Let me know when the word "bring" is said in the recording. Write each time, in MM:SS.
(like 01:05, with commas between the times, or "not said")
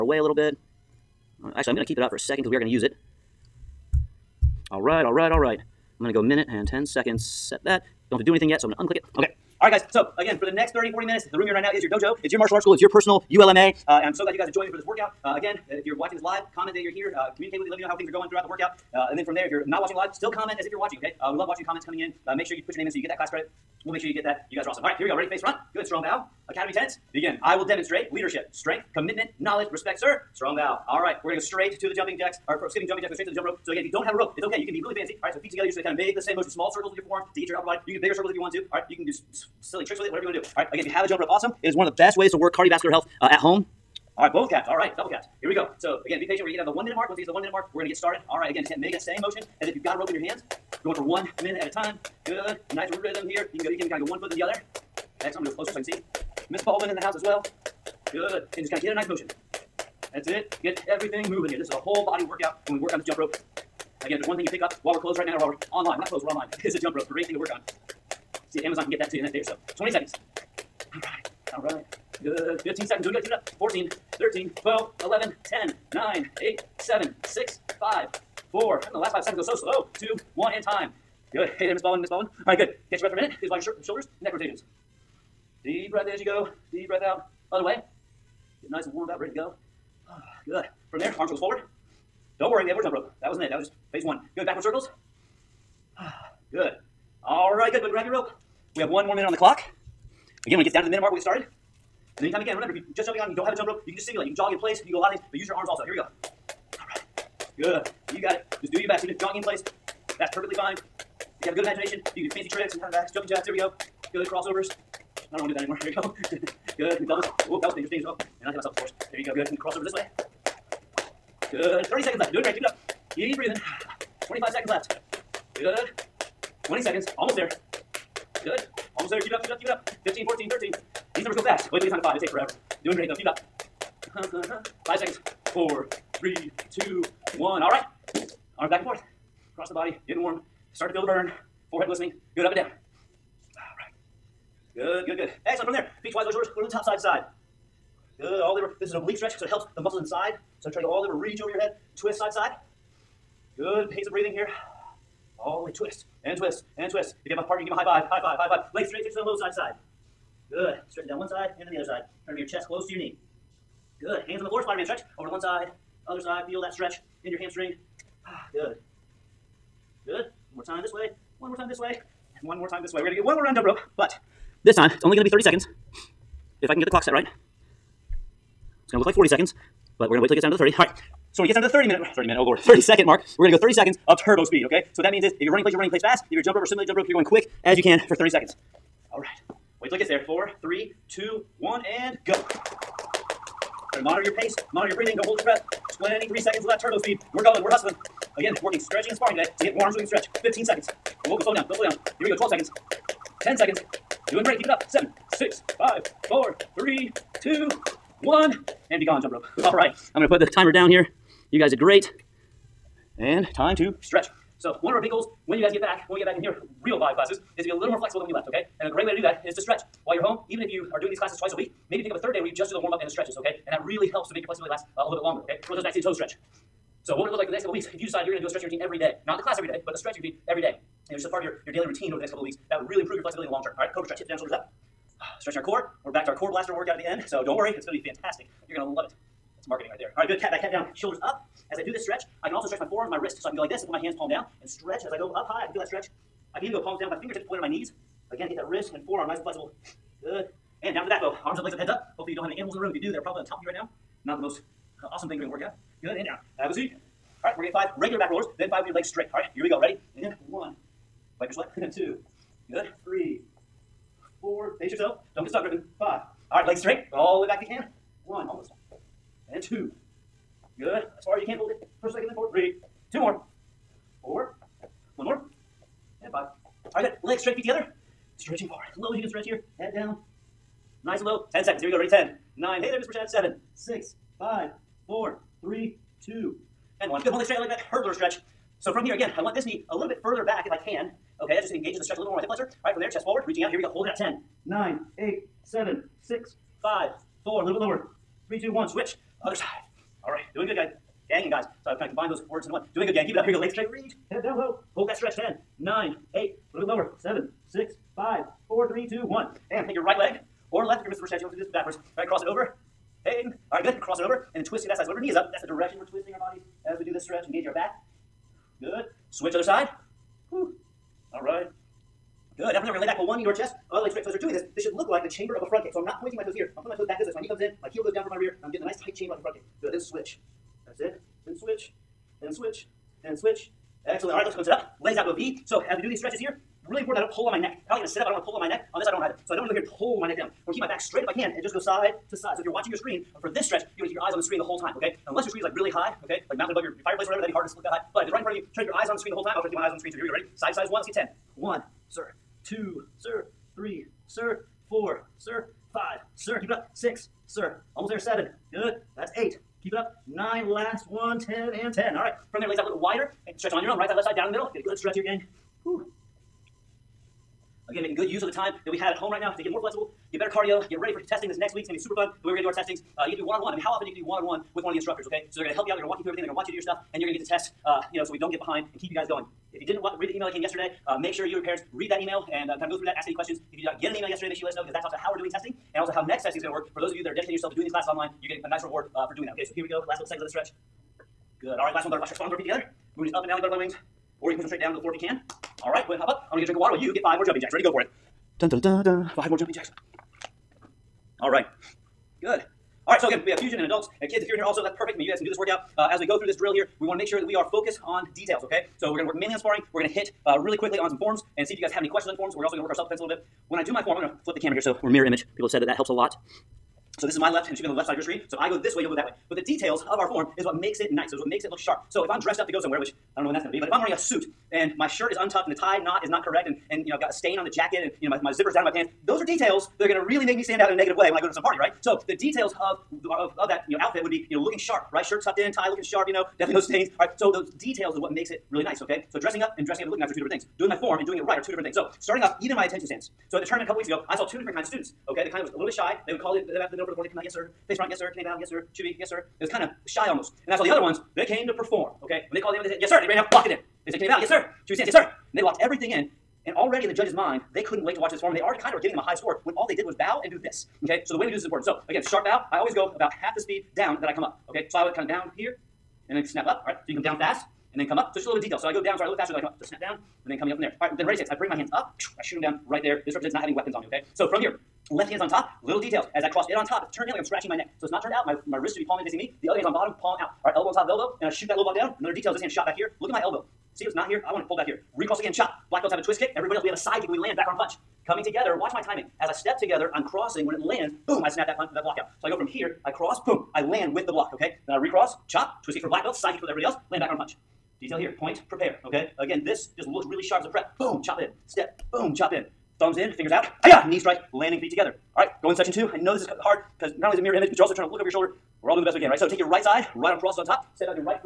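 07:51.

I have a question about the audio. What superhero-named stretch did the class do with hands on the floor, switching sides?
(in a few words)
Spider-Man stretch.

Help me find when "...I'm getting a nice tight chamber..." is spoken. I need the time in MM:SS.
05:28.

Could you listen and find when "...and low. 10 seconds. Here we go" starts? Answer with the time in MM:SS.
04:41.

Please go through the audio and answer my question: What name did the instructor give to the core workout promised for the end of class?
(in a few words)
core blaster.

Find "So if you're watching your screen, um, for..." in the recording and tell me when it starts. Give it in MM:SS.
05:42.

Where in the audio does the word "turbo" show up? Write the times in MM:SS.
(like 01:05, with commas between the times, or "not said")
03:04, 03:16.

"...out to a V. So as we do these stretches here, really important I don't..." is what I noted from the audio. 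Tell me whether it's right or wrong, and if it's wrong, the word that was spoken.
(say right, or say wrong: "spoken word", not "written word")
right.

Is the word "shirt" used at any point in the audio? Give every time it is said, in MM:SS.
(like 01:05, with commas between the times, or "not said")
07:05, 07:15.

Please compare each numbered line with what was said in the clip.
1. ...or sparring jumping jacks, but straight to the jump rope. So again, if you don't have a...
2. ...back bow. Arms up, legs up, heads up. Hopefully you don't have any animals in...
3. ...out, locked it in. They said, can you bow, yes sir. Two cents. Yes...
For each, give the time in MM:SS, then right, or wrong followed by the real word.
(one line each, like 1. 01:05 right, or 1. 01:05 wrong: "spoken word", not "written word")
1. 00:32 wrong: "skipping", not "sparring"
2. 04:11 right
3. 07:33 right.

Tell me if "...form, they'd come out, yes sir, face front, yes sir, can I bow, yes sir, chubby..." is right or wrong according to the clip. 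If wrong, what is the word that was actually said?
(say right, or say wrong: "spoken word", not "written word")
right.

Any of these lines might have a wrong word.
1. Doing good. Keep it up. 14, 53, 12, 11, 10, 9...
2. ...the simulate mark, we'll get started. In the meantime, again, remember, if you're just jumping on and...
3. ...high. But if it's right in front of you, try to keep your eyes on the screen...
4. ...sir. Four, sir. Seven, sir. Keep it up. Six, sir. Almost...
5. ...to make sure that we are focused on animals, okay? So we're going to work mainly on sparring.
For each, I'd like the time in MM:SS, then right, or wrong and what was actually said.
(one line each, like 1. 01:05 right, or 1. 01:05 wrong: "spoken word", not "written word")
1. 01:13 wrong: "13", not "53"
2. 01:40 wrong: "minute", not "simulate"
3. 05:47 right
4. 05:54 wrong: "Five", not "Seven"
5. 06:47 wrong: "details", not "animals".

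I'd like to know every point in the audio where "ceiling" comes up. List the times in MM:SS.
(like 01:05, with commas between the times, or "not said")
not said.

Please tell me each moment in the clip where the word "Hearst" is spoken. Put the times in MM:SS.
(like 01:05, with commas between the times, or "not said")
not said.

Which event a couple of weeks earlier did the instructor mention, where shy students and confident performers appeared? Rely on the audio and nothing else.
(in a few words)
tournament.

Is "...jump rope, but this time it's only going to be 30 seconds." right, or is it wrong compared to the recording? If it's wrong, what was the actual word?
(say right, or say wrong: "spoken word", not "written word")
right.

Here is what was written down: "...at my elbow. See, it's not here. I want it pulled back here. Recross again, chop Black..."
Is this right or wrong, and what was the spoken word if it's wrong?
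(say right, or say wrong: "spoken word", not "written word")
right.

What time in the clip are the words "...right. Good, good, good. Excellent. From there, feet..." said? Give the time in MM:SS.
02:23.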